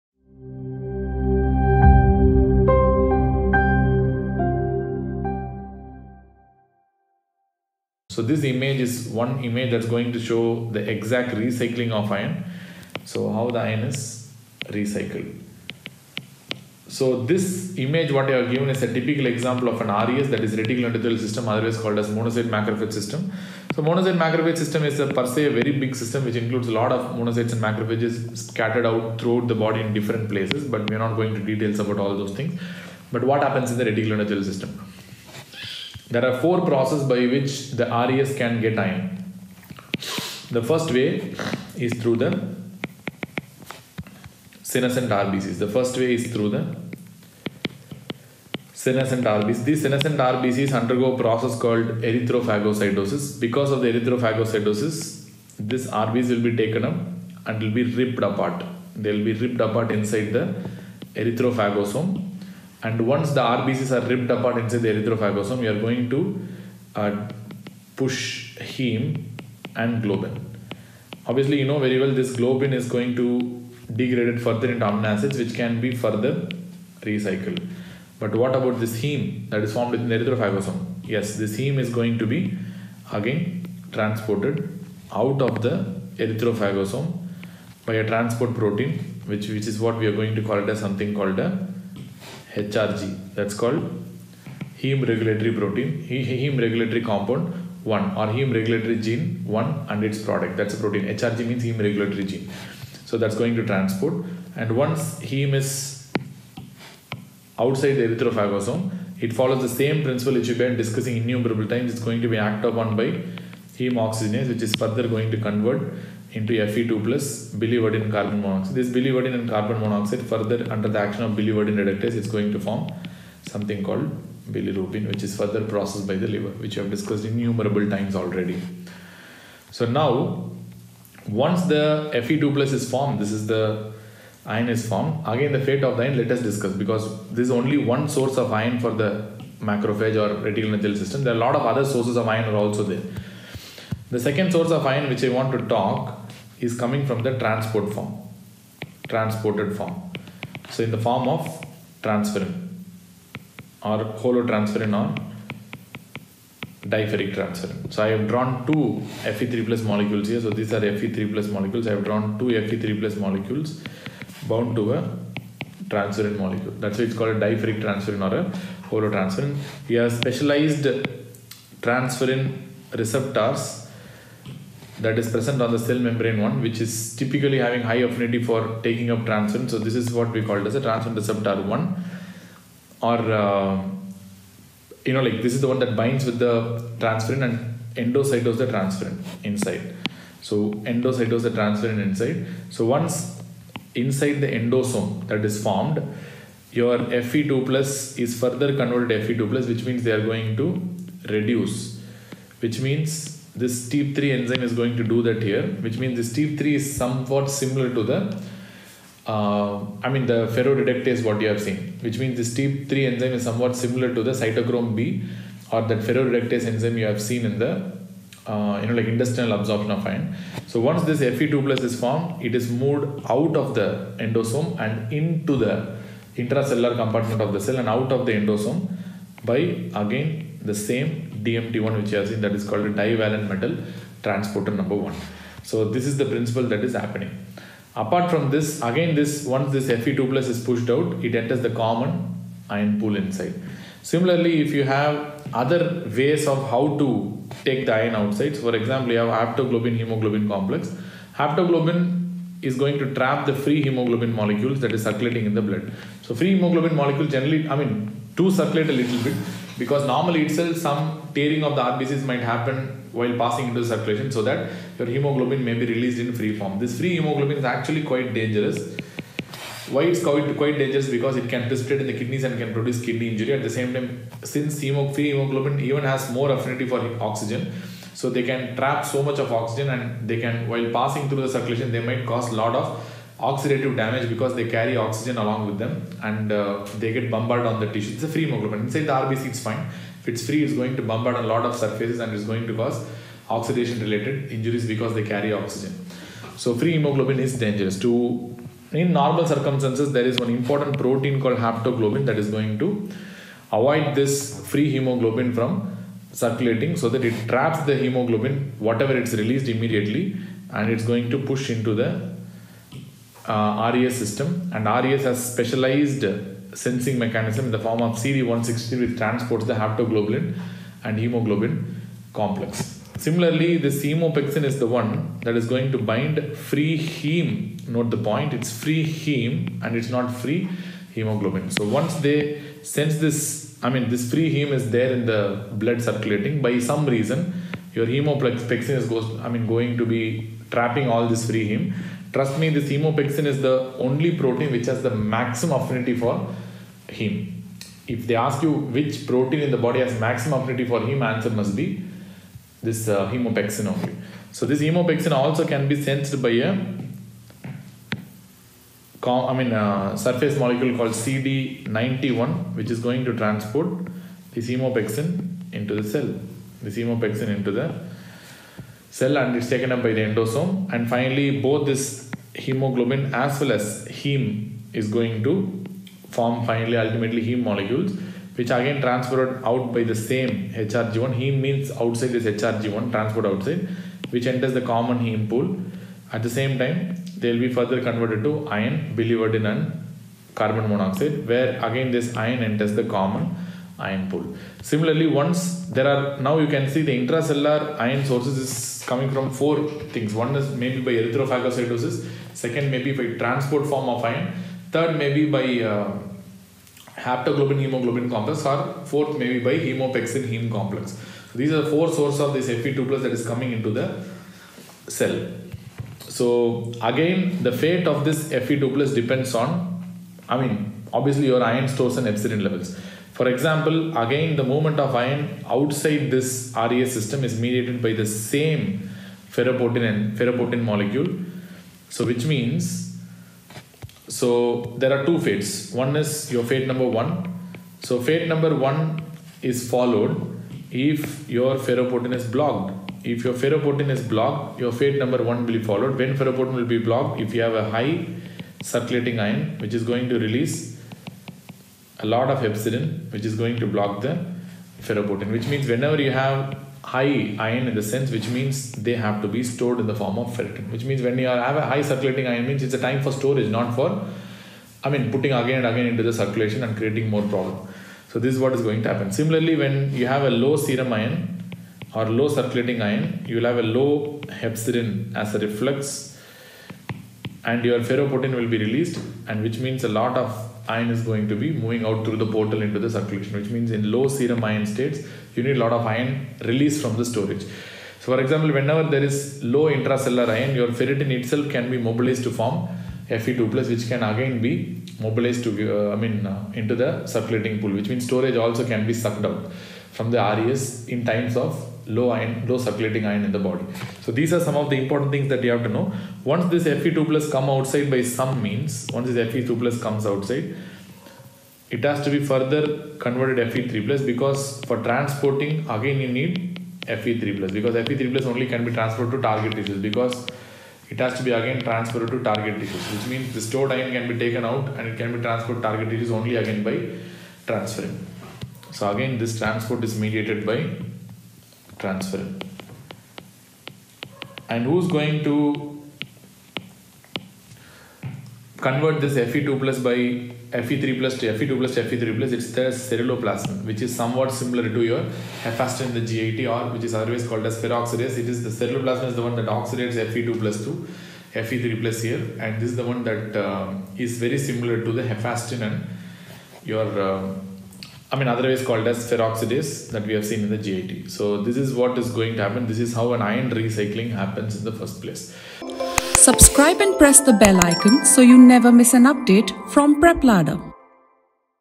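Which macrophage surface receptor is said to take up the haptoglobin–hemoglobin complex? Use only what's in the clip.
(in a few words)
CD160.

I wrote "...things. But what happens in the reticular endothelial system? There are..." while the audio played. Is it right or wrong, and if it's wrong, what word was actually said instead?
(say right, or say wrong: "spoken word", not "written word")
right.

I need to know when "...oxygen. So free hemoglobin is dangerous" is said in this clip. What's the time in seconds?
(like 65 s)
295 s.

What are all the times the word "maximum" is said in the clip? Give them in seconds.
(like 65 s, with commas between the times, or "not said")
345 s, 350 s.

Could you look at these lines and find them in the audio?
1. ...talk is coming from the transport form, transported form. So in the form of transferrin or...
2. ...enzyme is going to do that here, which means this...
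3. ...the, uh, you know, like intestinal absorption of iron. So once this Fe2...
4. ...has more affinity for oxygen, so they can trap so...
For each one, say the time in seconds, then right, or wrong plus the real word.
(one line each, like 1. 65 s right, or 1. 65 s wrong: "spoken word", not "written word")
1. 145 s right
2. 204 s right
3. 217 s right
4. 276 s right.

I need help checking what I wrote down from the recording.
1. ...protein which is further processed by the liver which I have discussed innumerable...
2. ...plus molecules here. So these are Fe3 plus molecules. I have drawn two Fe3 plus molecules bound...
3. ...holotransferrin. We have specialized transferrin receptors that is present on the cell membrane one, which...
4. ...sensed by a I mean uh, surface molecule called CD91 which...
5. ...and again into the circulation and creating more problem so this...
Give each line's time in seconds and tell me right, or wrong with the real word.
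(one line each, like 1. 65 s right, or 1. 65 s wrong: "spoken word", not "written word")
1. 124 s wrong: "bilirubin", not "protein"
2. 159 s right
3. 168 s right
4. 356 s right
5. 465 s right.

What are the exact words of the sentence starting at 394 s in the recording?
Similarly, once there are now you can see the intracellular ion sources is coming from four things.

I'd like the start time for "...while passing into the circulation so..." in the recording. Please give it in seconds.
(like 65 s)
263 s.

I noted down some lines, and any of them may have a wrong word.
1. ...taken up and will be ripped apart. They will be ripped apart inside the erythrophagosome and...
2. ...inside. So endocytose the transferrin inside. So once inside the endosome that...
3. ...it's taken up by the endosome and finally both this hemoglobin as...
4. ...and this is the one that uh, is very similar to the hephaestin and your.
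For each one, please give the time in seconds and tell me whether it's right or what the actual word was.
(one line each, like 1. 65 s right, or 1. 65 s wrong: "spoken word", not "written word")
1. 56 s right
2. 189 s right
3. 369 s right
4. 552 s right.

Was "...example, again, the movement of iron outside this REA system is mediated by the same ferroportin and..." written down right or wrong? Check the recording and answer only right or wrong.
right.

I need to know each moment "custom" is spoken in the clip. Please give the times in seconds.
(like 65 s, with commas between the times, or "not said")
not said.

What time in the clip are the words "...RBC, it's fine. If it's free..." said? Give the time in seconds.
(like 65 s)
289 s.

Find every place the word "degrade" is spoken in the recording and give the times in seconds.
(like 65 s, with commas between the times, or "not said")
73 s.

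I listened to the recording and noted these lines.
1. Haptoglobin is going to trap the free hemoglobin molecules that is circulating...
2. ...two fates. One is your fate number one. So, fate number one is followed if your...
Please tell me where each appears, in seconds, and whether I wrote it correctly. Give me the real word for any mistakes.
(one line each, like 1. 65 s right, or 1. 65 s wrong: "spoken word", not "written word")
1. 251 s right
2. 435 s right.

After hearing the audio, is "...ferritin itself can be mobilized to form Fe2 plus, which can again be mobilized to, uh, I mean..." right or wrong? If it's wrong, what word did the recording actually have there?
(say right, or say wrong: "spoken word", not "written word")
right.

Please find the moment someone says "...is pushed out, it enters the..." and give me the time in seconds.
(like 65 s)
240 s.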